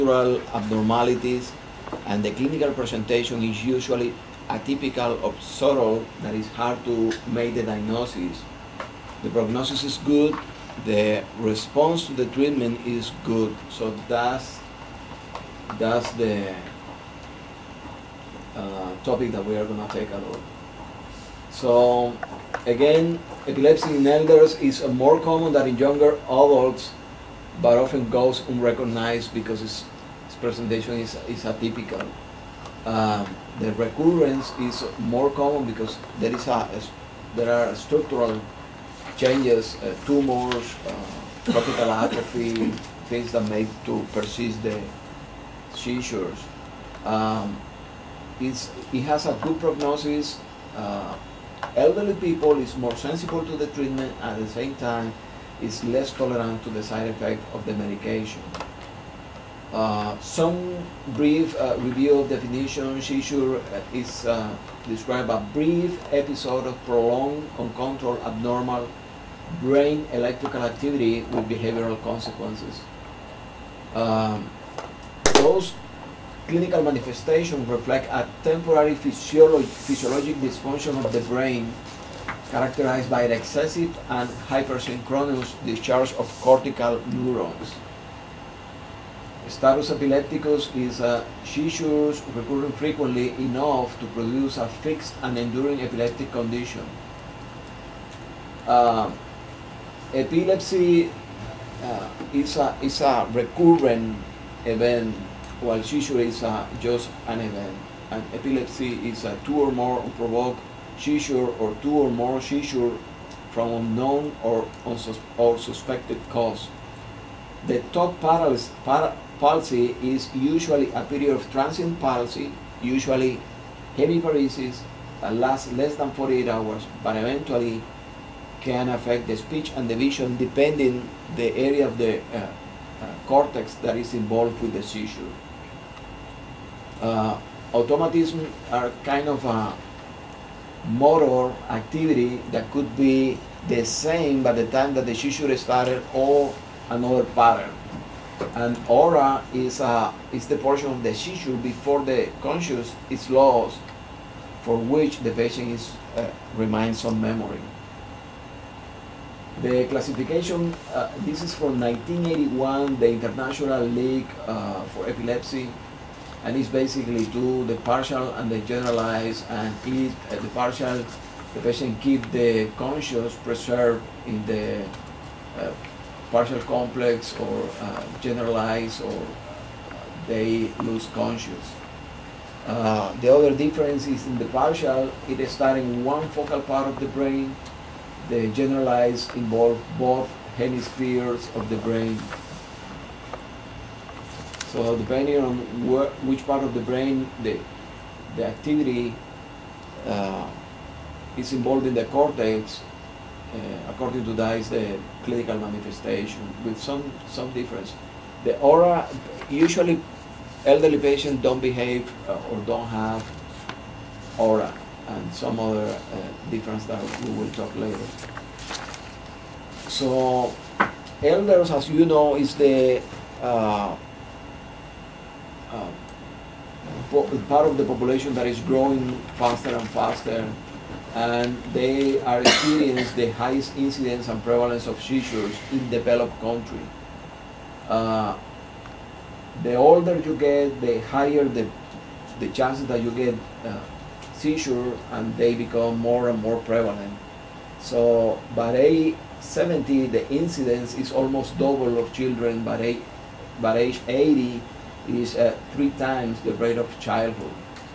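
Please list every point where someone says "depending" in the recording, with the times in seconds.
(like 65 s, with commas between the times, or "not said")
130 s, 194 s.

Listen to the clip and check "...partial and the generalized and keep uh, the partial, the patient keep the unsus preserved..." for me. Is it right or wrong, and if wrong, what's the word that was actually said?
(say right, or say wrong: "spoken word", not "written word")
wrong: "conscious", not "unsus".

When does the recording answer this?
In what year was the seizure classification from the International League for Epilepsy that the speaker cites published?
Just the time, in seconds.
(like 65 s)
161 s.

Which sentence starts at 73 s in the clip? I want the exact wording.
Um, those clinical manifestations reflect a temporary physiologic dysfunction of the brain characterized by an excessive and hypersynchronous discharge of cortical neurons.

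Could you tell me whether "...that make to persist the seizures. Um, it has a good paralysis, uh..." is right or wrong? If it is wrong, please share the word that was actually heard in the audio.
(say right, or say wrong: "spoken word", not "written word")
wrong: "prognosis", not "paralysis".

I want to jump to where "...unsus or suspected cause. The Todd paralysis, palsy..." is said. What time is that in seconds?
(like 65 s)
114 s.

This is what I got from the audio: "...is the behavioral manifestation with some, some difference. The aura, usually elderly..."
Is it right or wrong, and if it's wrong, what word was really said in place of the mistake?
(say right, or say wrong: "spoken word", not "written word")
wrong: "clinical", not "behavioral".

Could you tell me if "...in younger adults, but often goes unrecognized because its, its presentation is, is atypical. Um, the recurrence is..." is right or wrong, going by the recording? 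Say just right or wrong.
right.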